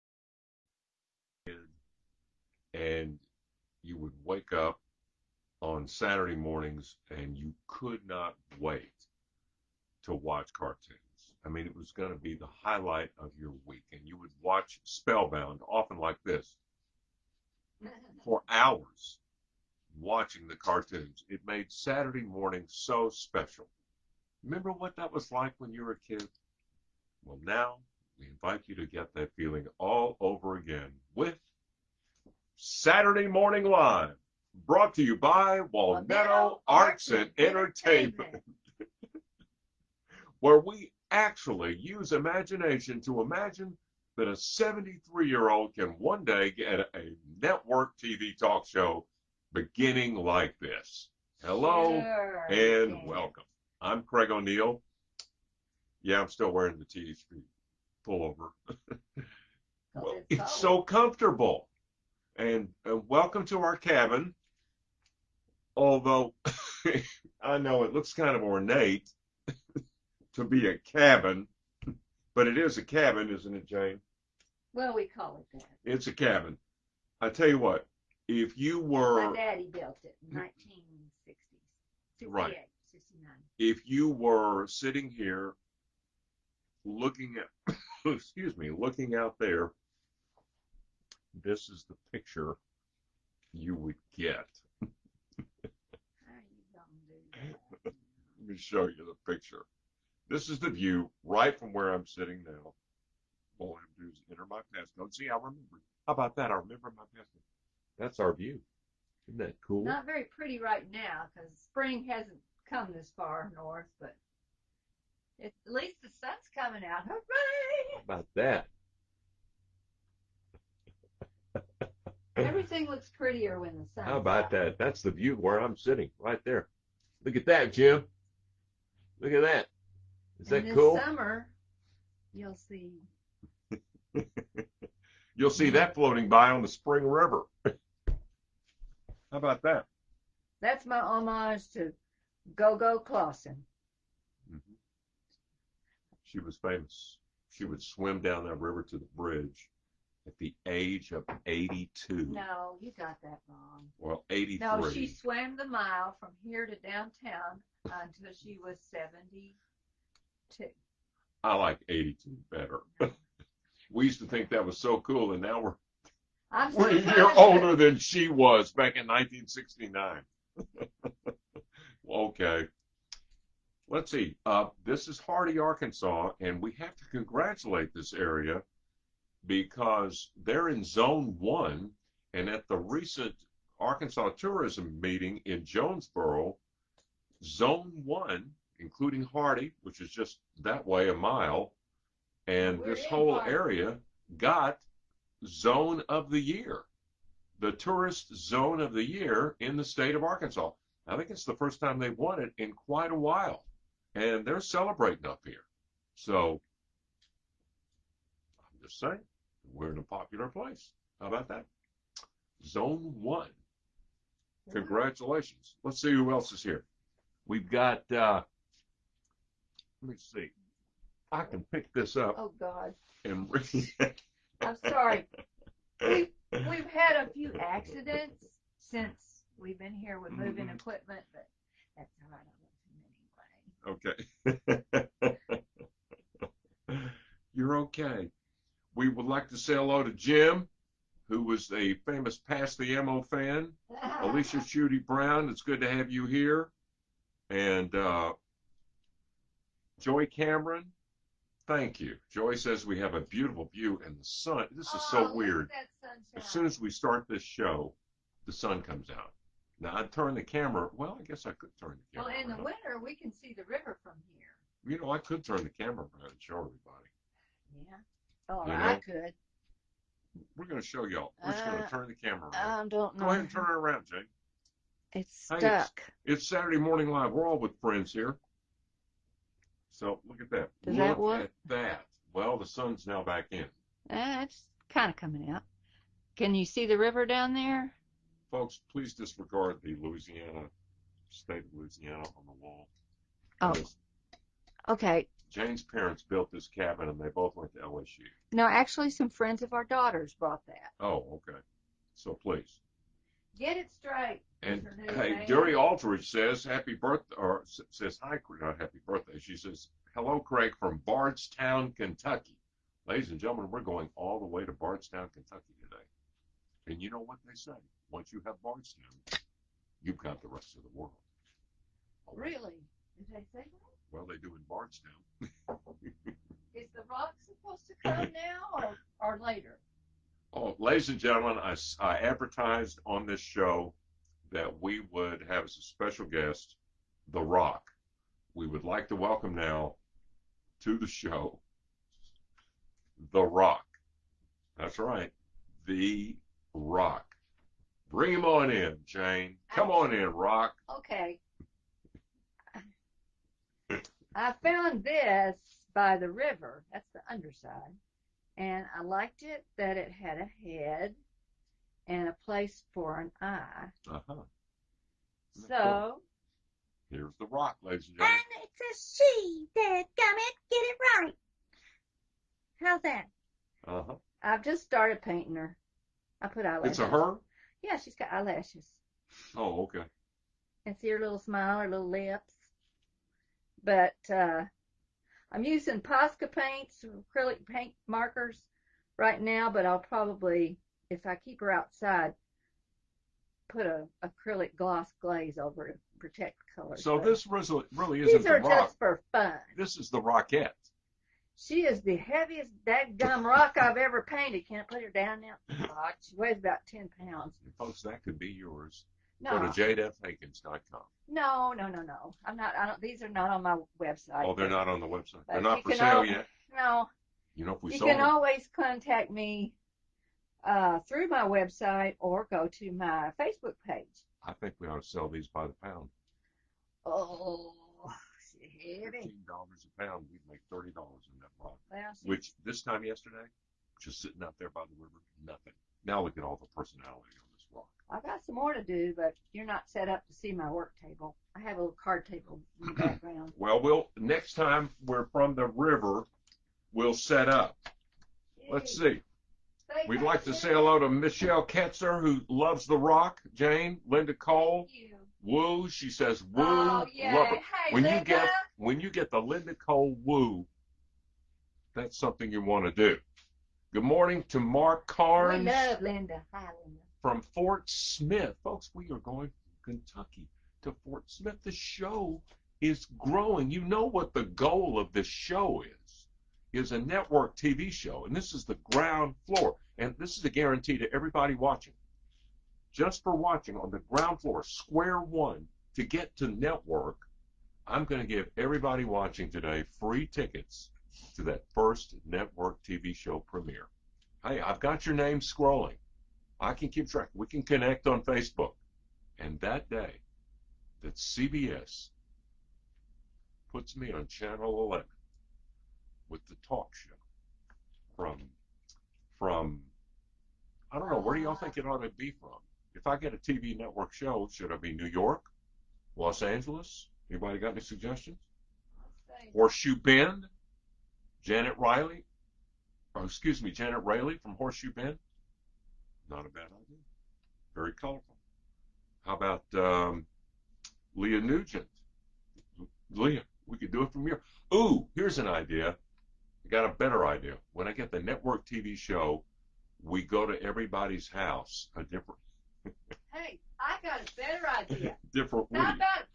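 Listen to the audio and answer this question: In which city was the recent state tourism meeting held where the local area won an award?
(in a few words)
Jonesboro.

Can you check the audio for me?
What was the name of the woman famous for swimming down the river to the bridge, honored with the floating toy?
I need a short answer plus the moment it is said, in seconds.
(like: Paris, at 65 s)
Go Go Clausen, at 142 s.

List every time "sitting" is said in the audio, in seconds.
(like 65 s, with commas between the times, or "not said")
84 s, 102 s, 125 s, 434 s.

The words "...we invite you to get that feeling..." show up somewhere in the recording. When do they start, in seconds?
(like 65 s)
28 s.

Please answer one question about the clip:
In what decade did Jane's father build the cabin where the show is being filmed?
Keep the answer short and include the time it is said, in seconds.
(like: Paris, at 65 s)
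1960s, at 80 s.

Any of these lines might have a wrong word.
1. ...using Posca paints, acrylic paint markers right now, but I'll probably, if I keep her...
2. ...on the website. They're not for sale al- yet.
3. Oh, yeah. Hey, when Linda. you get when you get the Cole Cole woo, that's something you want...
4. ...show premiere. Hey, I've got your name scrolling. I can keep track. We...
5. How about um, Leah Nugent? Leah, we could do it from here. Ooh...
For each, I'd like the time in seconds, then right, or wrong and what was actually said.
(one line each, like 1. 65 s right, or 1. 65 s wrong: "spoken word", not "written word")
1. 385 s right
2. 414 s right
3. 456 s wrong: "Linda", not "Cole"
4. 493 s right
5. 529 s right.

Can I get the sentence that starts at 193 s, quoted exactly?
area got zone of the year, the tourist zone of the year in the state of Arkansas.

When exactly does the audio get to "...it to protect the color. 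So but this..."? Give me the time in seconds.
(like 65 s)
395 s.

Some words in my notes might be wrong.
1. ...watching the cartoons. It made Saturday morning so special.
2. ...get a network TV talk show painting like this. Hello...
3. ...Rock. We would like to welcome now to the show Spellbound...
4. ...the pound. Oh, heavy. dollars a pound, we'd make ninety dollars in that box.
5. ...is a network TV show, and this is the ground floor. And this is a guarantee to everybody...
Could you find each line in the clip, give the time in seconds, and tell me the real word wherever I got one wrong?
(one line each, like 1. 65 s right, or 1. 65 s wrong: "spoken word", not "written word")
1. 19 s right
2. 46 s wrong: "beginning", not "painting"
3. 337 s wrong: "The", not "Spellbound"
4. 425 s wrong: "thirty", not "ninety"
5. 476 s right.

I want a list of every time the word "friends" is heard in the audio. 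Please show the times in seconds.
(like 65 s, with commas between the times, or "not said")
277 s, 299 s.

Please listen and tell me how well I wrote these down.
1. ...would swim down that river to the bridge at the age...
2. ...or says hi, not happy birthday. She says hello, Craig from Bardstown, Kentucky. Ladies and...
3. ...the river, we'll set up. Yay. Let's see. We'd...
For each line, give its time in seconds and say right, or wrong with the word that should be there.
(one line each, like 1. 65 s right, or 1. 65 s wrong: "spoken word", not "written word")
1. 147 s right
2. 307 s right
3. 445 s right.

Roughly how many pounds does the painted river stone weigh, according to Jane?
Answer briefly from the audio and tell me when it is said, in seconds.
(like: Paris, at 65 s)
10 pounds, at 406 s.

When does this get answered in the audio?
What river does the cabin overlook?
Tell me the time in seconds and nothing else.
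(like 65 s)
136 s.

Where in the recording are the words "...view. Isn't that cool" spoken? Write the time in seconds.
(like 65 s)
108 s.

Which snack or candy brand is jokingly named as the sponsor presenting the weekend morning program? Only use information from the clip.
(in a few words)
Walnetto.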